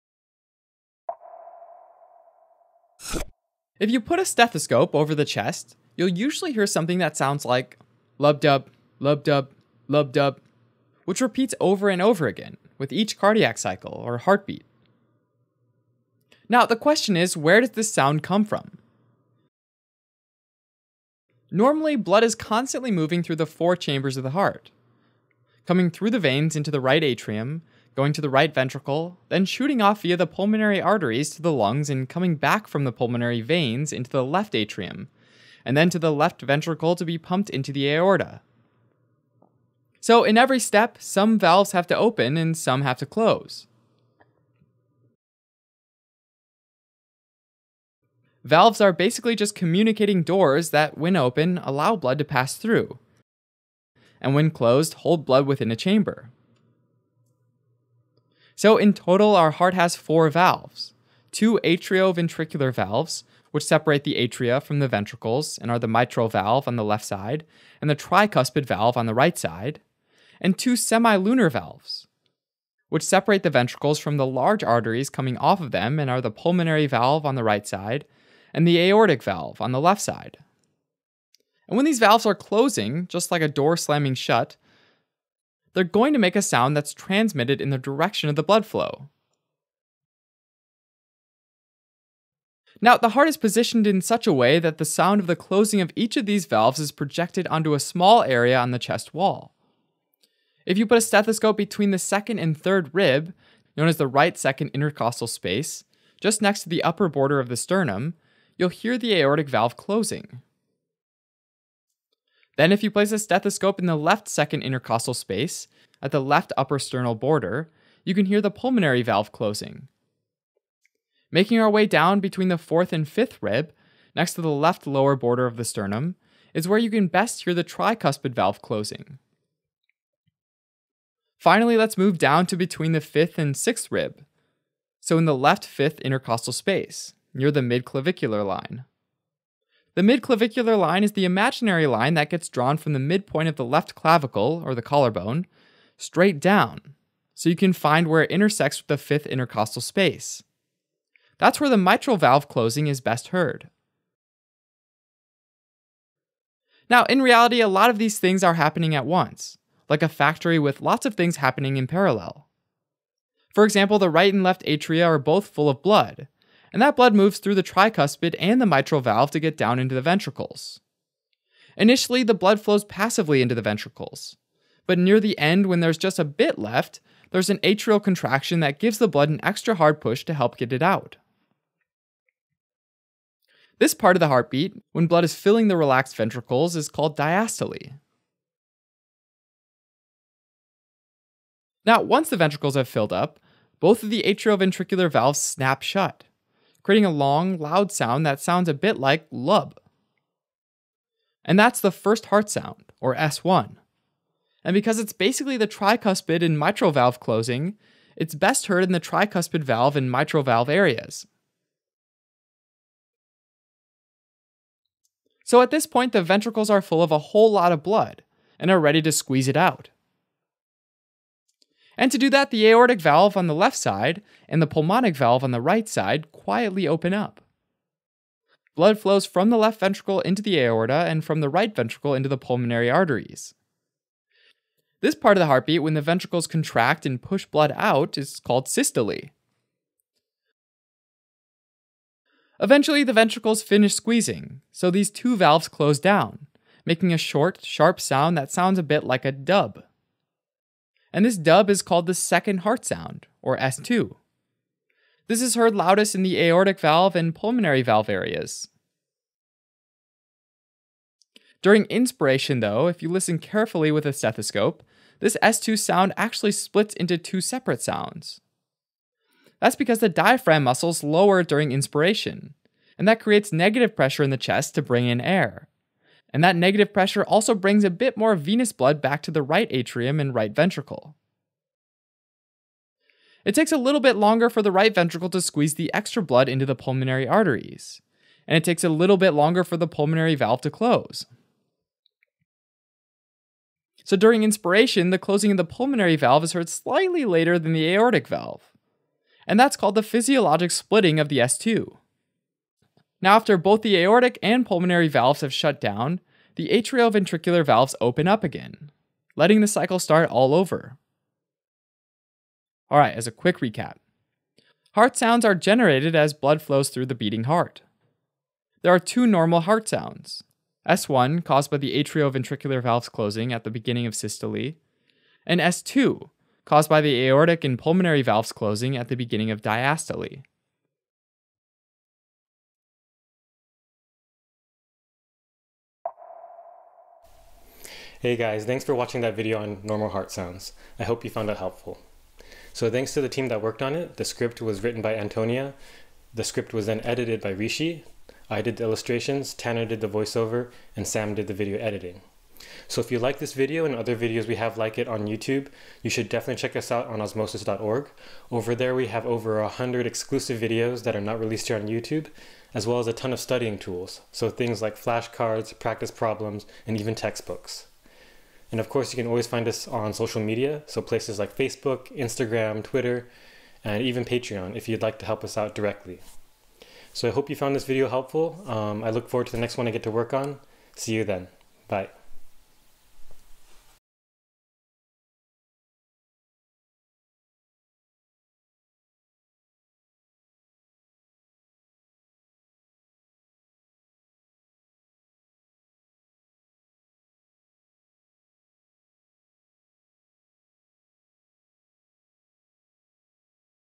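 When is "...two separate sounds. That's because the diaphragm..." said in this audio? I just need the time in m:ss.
4:27.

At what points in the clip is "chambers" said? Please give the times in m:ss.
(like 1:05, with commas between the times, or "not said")
0:23, 0:55.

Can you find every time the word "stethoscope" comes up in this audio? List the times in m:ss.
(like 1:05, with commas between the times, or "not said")
0:04, 1:41, 1:53, 4:24.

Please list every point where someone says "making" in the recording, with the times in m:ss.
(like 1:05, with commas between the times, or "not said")
2:01, 4:06.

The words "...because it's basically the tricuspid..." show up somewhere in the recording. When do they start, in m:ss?
3:24.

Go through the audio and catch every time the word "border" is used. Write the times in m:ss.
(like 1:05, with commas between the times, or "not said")
1:47, 1:57, 2:05.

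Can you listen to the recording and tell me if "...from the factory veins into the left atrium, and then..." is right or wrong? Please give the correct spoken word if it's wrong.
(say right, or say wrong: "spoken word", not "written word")
wrong: "pulmonary", not "factory".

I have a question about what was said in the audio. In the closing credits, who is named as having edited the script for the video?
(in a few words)
Rishi.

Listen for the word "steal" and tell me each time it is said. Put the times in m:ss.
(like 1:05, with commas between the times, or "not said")
not said.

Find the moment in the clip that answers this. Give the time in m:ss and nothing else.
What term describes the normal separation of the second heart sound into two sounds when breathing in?
5:00.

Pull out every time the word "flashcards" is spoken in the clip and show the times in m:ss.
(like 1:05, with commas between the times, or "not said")
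6:04.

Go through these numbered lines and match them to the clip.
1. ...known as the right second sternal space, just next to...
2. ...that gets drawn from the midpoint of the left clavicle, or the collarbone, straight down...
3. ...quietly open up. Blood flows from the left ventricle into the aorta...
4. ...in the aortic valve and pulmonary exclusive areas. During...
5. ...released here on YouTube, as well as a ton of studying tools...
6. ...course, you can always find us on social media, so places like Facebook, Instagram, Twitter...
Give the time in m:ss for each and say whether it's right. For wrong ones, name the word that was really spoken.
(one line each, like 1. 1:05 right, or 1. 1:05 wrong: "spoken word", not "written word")
1. 1:43 wrong: "intercostal", not "sternal"
2. 2:22 right
3. 3:46 right
4. 4:16 wrong: "valve", not "exclusive"
5. 6:01 right
6. 6:08 right.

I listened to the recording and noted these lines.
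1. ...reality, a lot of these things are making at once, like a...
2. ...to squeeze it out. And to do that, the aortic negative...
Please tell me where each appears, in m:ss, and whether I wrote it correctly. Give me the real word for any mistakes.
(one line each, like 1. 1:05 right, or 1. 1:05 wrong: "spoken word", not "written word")
1. 2:37 wrong: "happening", not "making"
2. 3:39 wrong: "valve", not "negative".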